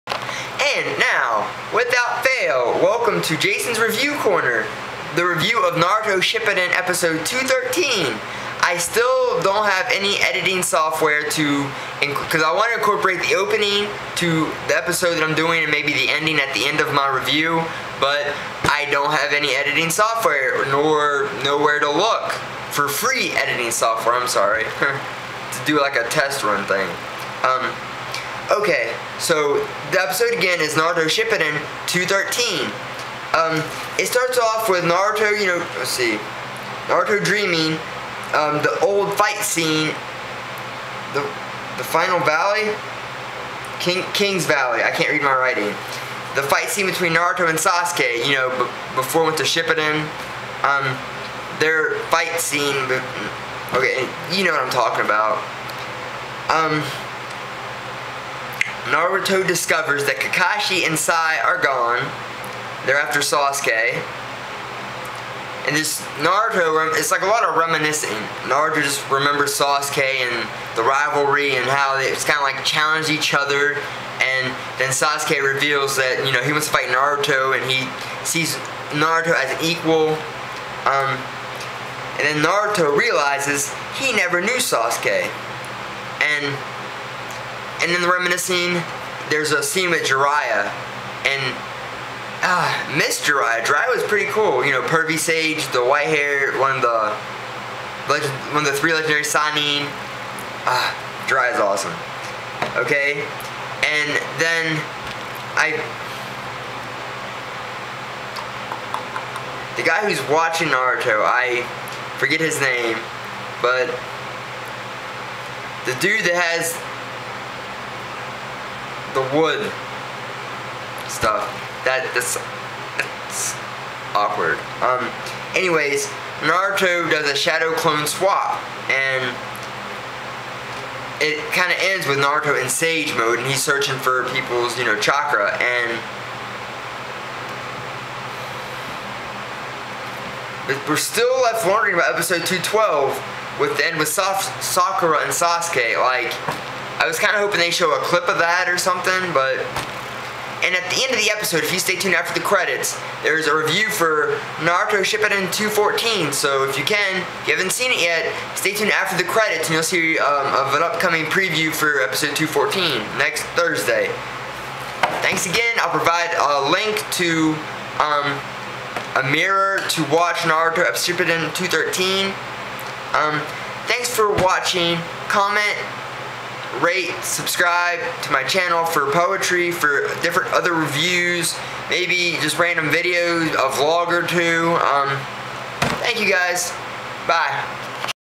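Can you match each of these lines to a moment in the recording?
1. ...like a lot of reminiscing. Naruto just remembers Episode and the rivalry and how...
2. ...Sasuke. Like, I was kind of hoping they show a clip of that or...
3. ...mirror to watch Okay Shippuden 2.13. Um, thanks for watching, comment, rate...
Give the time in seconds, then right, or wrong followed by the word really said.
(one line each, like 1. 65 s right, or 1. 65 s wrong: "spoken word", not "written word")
1. 67 s wrong: "Sasuke", not "Episode"
2. 145 s right
3. 169 s wrong: "Naruto", not "Okay".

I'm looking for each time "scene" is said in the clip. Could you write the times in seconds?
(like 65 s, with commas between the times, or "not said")
39 s, 46 s, 52 s, 89 s.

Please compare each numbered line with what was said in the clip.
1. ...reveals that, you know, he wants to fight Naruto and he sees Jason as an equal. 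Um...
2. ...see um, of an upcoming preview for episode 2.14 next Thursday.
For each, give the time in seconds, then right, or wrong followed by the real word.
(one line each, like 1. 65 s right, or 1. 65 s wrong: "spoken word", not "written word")
1. 75 s wrong: "Naruto", not "Jason"
2. 159 s right.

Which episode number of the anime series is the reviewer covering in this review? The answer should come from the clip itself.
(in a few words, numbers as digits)
213.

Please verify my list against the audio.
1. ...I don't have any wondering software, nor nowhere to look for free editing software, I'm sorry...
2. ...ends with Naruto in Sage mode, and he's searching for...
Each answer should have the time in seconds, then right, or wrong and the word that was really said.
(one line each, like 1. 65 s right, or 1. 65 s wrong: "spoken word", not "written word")
1. 18 s wrong: "editing", not "wondering"
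2. 131 s right.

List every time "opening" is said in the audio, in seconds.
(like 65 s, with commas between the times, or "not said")
13 s.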